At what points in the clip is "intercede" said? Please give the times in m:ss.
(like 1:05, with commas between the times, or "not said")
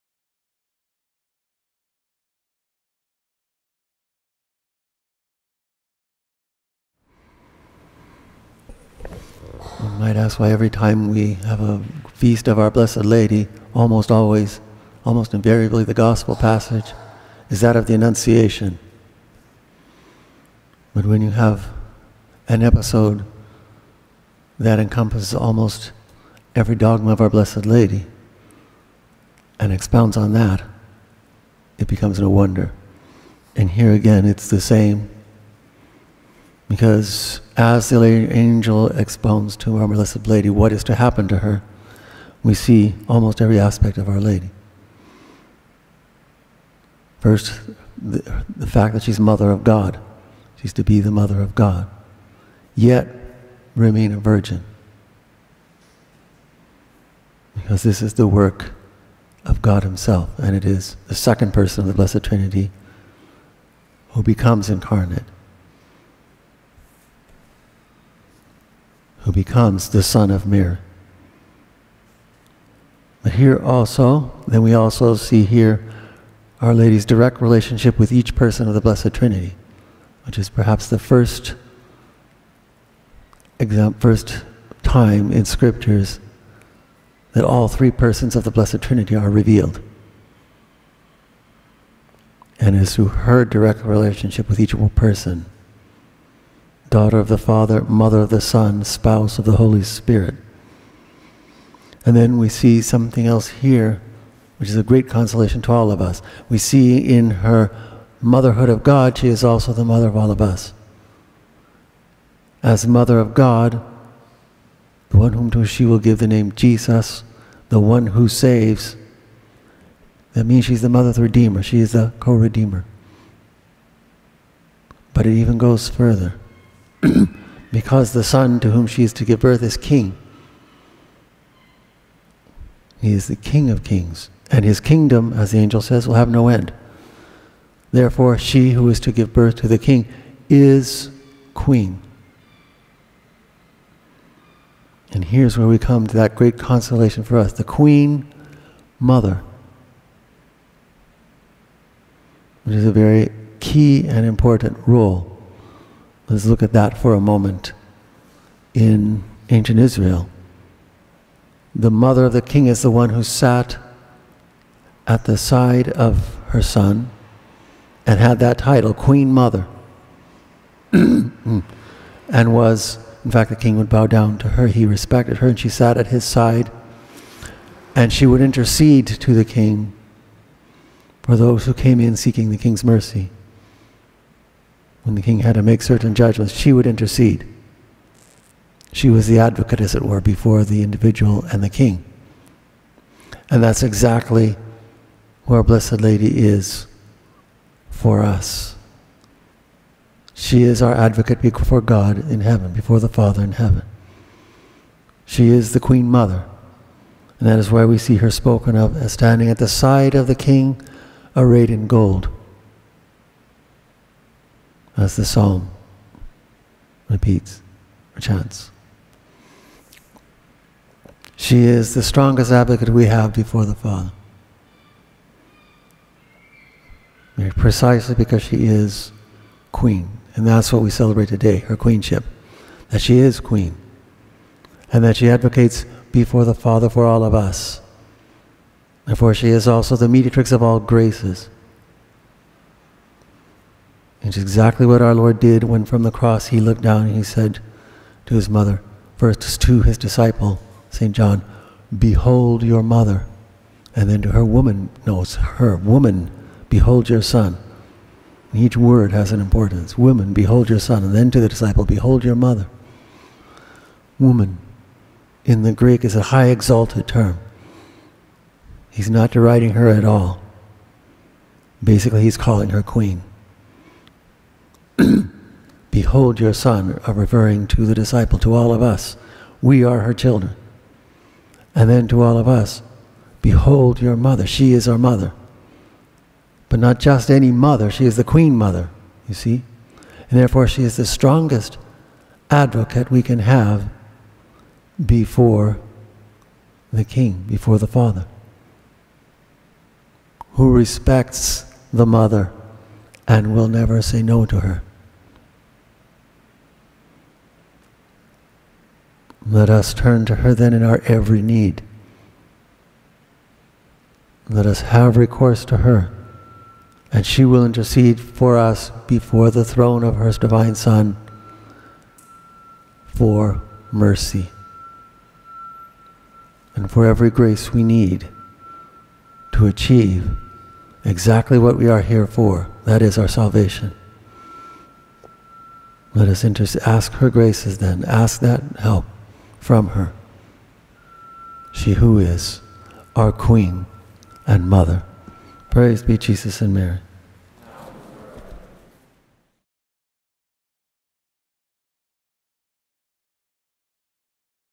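2:58, 3:06, 5:17.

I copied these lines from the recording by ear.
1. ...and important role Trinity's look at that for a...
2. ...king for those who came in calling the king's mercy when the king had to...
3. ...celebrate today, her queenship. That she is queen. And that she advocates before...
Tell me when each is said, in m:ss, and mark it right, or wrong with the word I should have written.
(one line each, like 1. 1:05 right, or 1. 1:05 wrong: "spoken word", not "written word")
1. 2:34 wrong: "Let", not "Trinity"
2. 2:59 wrong: "seeking", not "calling"
3. 3:50 right.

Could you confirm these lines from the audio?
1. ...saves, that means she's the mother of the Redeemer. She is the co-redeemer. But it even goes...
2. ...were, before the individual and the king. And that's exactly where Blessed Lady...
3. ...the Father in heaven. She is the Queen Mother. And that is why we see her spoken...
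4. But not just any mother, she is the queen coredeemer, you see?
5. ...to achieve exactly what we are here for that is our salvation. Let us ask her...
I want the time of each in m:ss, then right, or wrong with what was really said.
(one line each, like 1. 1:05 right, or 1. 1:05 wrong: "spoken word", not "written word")
1. 1:58 right
2. 3:10 right
3. 3:22 right
4. 4:46 wrong: "mother", not "coredeemer"
5. 5:29 right.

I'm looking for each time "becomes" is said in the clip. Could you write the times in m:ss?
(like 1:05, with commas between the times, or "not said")
0:31, 1:04, 1:09.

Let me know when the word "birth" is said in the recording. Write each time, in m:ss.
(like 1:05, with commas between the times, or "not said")
2:09, 2:19.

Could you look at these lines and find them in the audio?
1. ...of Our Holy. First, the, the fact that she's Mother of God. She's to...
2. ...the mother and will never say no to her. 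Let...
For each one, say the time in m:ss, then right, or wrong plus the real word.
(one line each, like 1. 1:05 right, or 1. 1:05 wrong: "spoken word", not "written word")
1. 0:43 wrong: "Lady", not "Holy"
2. 5:01 right.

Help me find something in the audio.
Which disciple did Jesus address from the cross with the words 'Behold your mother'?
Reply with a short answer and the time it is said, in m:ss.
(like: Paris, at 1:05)
St. John, at 4:10.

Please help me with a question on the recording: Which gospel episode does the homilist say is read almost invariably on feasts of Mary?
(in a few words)
The Annunciation.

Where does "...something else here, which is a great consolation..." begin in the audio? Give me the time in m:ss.
1:42.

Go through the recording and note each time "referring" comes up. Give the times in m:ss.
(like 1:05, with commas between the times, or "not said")
4:37.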